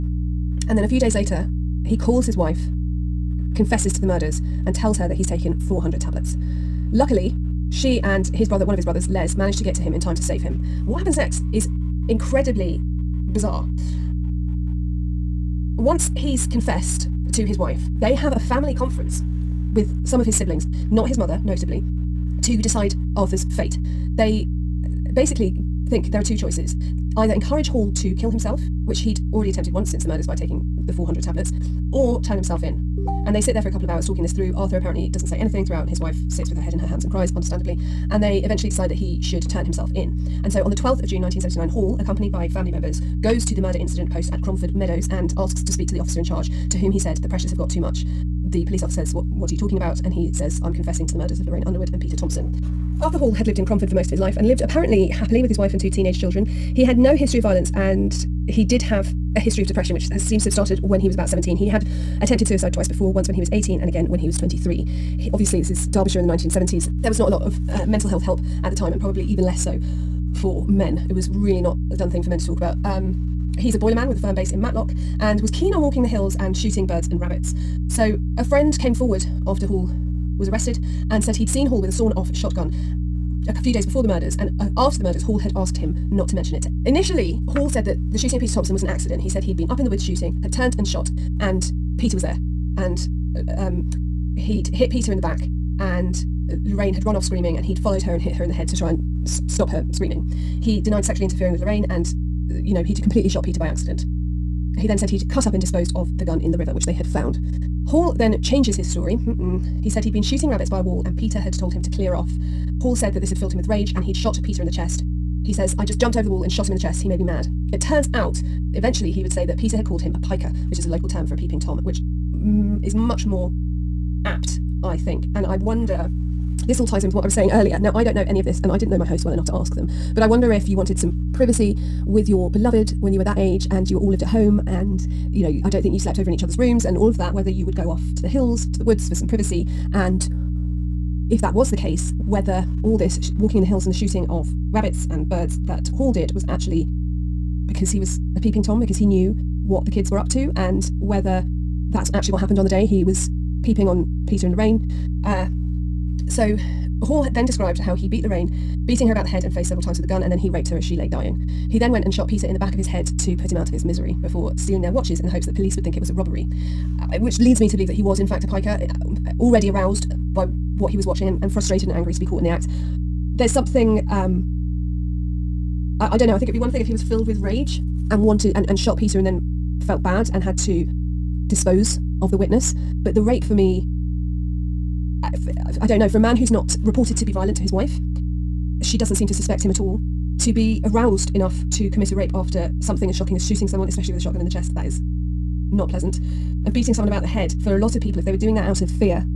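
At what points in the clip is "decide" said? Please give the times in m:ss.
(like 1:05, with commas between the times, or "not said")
0:22, 0:38.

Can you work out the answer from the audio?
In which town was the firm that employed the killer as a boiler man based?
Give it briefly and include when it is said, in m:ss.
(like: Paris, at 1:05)
Matlock, at 1:14.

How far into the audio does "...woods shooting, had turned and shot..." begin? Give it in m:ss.
1:29.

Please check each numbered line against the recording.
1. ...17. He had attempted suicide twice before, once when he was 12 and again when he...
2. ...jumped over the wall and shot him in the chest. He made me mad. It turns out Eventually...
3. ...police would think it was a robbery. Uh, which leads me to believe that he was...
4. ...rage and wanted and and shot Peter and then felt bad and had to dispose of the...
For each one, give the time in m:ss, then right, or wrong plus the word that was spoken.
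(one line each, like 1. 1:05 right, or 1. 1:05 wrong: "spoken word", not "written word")
1. 1:01 wrong: "18", not "12"
2. 1:55 right
3. 2:45 right
4. 2:57 right.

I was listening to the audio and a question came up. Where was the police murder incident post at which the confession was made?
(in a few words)
Cromford Meadows.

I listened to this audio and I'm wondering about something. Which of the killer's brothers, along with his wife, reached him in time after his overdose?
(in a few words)
Les.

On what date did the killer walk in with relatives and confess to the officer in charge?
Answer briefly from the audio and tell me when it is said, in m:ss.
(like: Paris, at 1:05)
12 June 1979, at 0:40.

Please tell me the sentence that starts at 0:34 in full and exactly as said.
Arthur apparently doesn't say anything throughout, and his wife sits with her head in her hands and cries, understandably.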